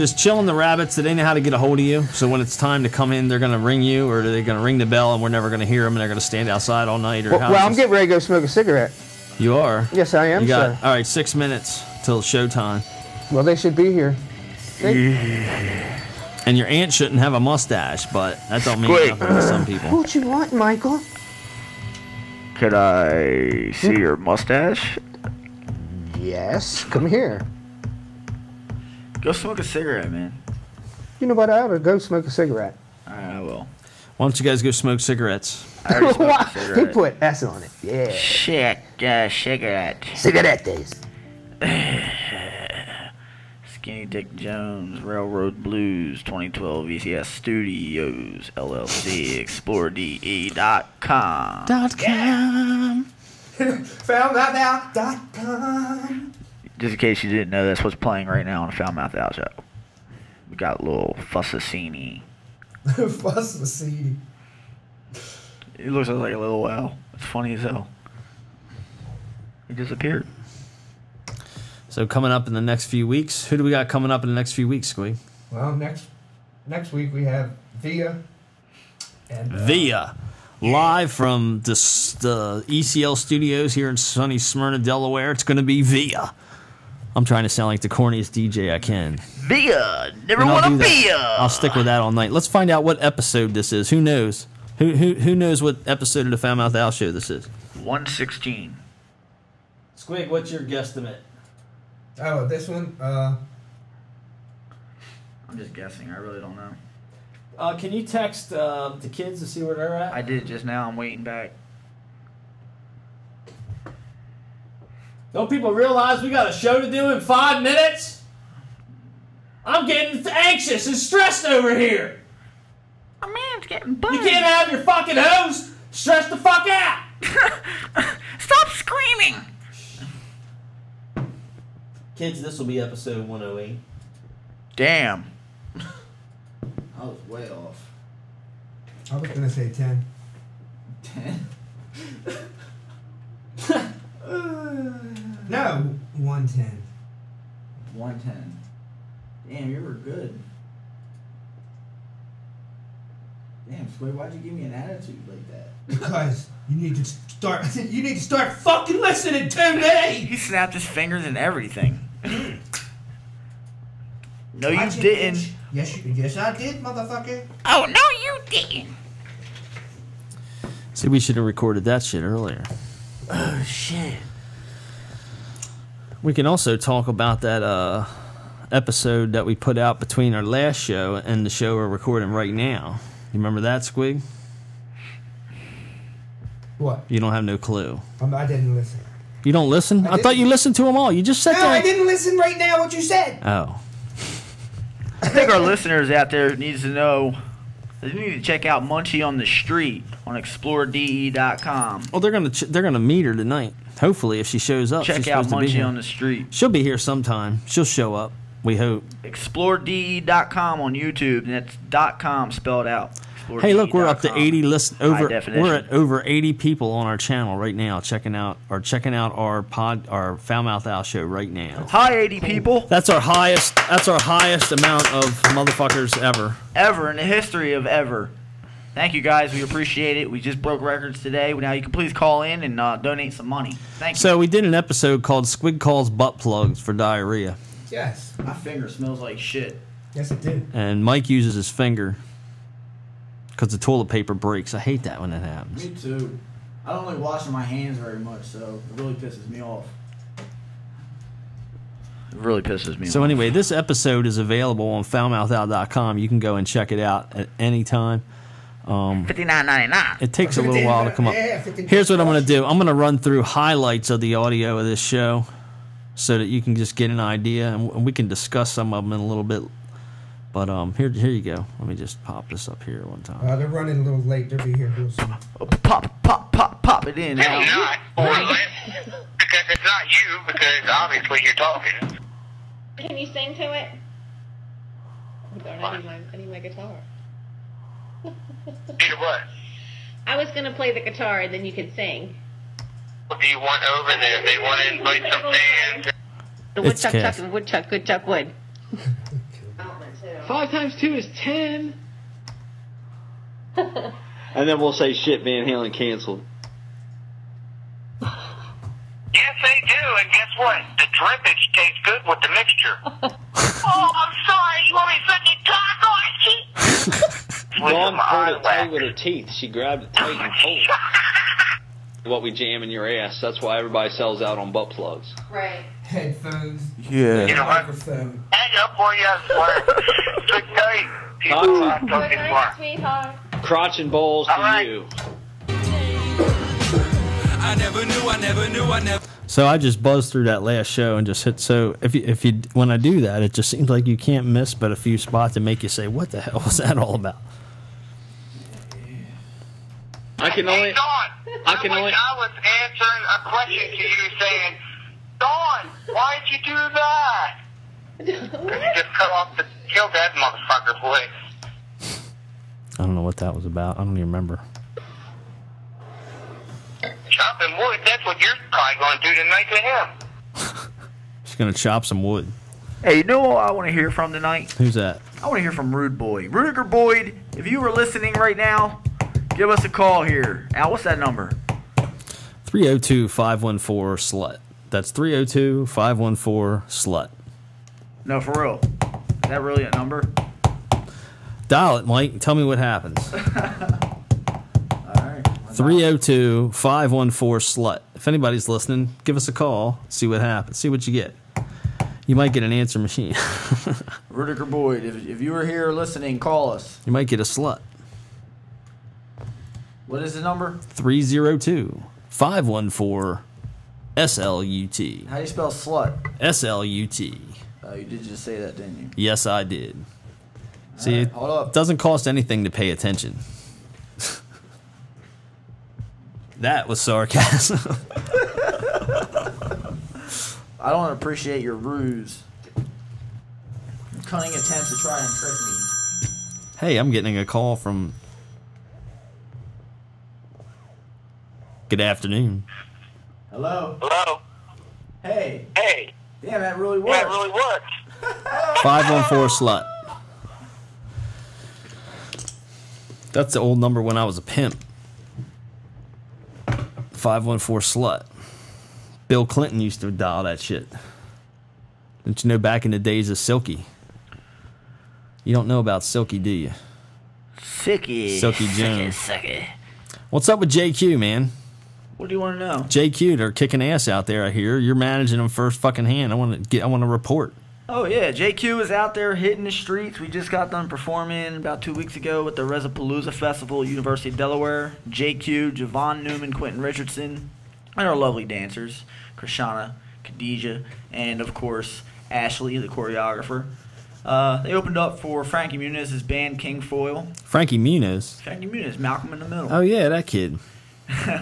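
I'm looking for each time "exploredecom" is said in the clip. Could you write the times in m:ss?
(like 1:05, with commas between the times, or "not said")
0:49, 3:20, 3:29.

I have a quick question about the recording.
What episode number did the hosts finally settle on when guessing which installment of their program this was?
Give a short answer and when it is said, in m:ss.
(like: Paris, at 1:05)
108, at 2:12.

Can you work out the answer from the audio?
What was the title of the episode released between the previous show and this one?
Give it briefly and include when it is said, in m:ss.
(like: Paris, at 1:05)
Squid Calls Butt Plugs for Diarrhea, at 3:55.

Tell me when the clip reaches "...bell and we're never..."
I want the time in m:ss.
0:04.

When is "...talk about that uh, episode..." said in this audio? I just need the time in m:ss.
2:56.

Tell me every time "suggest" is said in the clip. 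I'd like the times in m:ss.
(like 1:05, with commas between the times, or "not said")
not said.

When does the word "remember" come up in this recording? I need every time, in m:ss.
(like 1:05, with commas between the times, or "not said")
3:03, 6:04.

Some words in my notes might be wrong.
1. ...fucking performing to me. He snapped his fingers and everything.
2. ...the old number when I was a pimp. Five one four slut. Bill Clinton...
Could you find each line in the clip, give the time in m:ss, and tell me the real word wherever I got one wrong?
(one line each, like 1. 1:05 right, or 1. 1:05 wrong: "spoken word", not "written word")
1. 2:38 wrong: "listening", not "performing"
2. 7:33 right.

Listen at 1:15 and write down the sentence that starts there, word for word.
Well, next next week we have Via and uh, Via live from the, the ECL studios here in sunny Smyrna, Delaware.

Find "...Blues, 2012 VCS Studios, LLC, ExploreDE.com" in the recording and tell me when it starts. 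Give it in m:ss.
0:45.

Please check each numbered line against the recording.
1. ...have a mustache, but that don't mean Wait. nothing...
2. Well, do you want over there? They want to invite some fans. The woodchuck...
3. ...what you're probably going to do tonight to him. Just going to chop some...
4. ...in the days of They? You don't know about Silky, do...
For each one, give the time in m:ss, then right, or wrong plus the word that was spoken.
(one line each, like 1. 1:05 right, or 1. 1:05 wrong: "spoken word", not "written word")
1. 0:17 right
2. 4:53 right
3. 6:08 right
4. 7:42 wrong: "Silky", not "They".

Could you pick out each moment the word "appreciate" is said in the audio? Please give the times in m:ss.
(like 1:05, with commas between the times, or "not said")
3:49, 7:11.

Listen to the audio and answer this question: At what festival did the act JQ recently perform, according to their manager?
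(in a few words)
Resapalooza Festival.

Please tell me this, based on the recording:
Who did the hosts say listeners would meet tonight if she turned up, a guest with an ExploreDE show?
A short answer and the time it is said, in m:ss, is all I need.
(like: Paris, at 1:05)
Munchie on the Street, at 3:18.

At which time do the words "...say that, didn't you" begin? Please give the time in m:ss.
6:58.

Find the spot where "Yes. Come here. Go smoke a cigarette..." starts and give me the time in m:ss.
0:26.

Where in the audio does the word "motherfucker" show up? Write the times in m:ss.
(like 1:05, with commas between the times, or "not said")
2:46, 3:45, 6:00.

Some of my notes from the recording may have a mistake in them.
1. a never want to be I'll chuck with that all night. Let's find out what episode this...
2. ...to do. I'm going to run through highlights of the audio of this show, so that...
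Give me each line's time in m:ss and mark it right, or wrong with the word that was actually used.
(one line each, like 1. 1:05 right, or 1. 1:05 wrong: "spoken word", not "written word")
1. 1:29 wrong: "stick", not "chuck"
2. 4:22 right.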